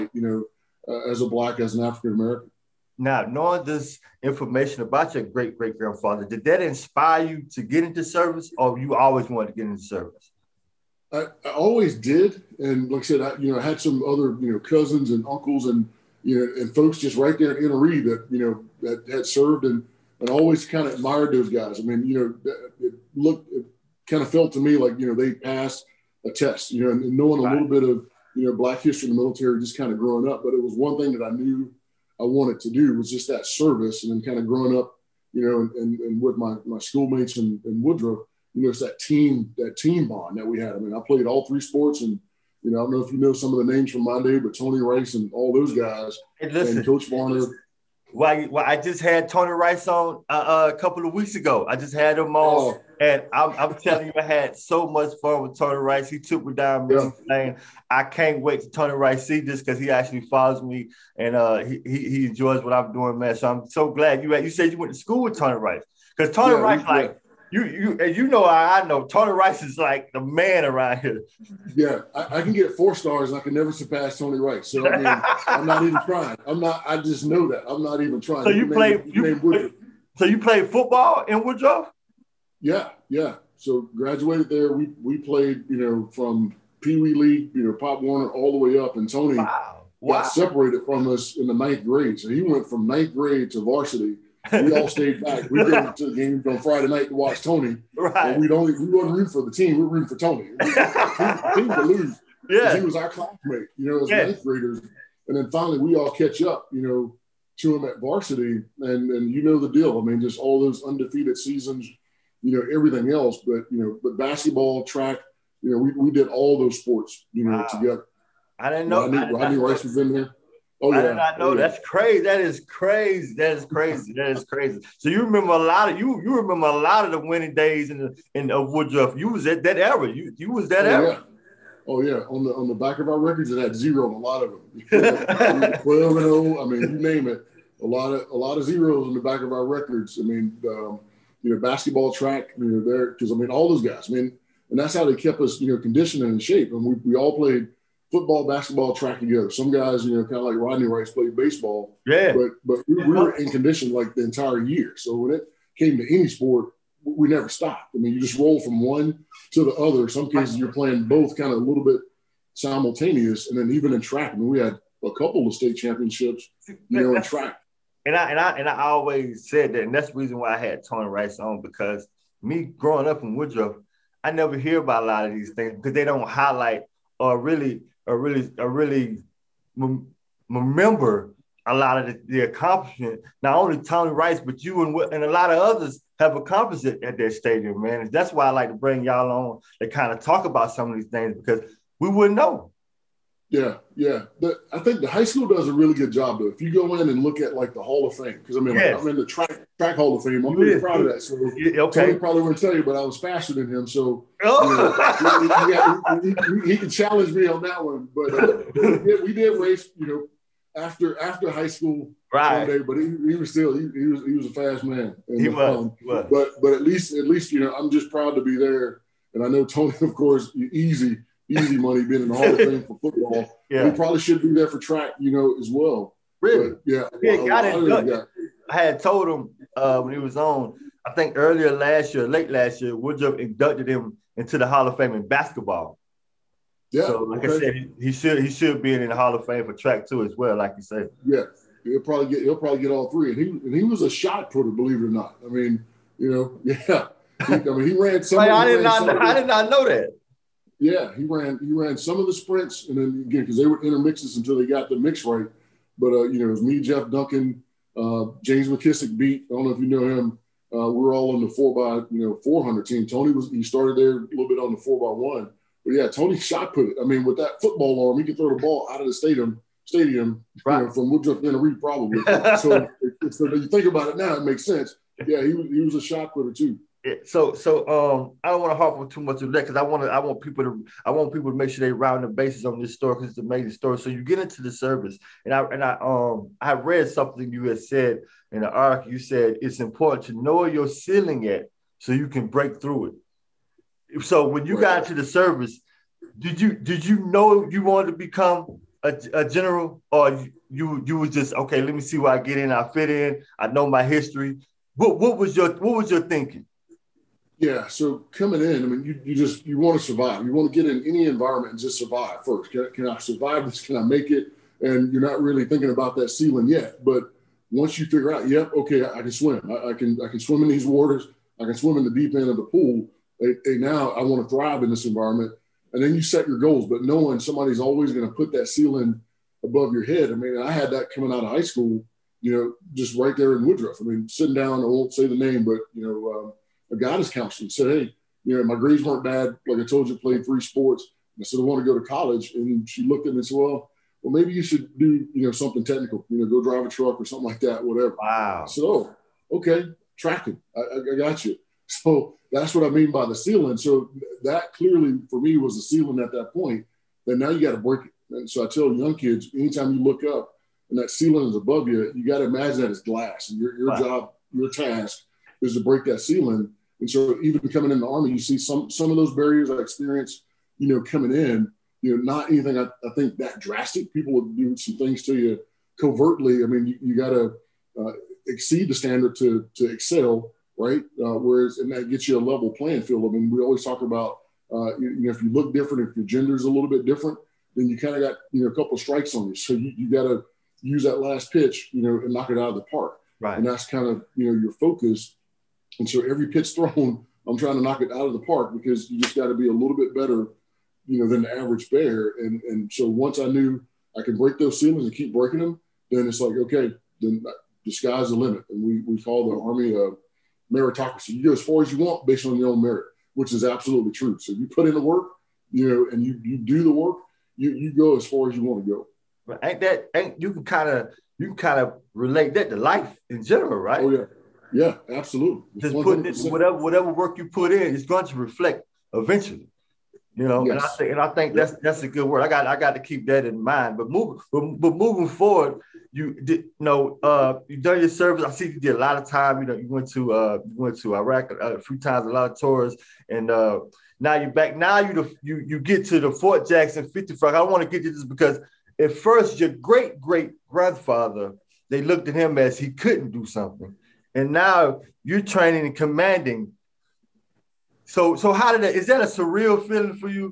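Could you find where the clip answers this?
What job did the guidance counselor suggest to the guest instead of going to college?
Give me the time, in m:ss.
5:46.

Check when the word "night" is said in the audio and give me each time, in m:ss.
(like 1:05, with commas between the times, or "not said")
1:36.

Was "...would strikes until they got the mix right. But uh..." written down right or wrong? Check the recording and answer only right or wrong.
wrong.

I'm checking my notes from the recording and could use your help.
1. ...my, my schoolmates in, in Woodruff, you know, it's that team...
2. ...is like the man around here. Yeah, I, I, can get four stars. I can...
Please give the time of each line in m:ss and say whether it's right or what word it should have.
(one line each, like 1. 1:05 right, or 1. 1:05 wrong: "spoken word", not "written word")
1. 0:36 right
2. 1:09 right.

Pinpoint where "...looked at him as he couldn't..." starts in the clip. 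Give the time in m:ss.
7:32.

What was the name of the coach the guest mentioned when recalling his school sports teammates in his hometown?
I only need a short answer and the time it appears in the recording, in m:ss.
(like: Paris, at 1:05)
Coach Varner, at 0:46.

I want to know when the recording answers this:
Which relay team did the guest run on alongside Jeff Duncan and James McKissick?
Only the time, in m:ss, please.
4:21.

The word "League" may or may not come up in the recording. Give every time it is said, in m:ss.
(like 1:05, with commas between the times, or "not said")
1:27.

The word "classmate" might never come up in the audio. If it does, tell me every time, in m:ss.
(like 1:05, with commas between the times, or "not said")
1:43.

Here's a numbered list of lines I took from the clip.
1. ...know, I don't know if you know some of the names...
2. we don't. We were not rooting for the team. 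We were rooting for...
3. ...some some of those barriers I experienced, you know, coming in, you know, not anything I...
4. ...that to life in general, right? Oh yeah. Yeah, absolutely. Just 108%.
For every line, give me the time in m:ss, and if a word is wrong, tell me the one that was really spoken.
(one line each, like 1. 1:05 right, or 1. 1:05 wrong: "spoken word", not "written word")
1. 0:42 right
2. 1:38 right
3. 6:08 right
4. 7:02 wrong: "100", not "108".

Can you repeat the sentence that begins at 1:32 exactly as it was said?
So he went from ninth grade to varsity we all stayed back.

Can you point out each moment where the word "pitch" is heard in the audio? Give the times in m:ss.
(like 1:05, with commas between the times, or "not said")
6:31, 6:36.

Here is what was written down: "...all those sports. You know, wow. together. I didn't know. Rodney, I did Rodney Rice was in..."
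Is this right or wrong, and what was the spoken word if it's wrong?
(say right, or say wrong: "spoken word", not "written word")
right.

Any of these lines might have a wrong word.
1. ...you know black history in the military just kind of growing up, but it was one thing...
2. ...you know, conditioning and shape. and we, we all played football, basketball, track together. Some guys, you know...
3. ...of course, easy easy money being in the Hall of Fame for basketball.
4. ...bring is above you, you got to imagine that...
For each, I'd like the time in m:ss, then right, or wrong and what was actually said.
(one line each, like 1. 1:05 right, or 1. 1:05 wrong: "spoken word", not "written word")
1. 0:28 right
2. 2:25 right
3. 3:40 wrong: "football", not "basketball"
4. 6:01 wrong: "ceiling", not "bring".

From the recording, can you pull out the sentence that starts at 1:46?
You know, to him at varsity, and and you know the deal.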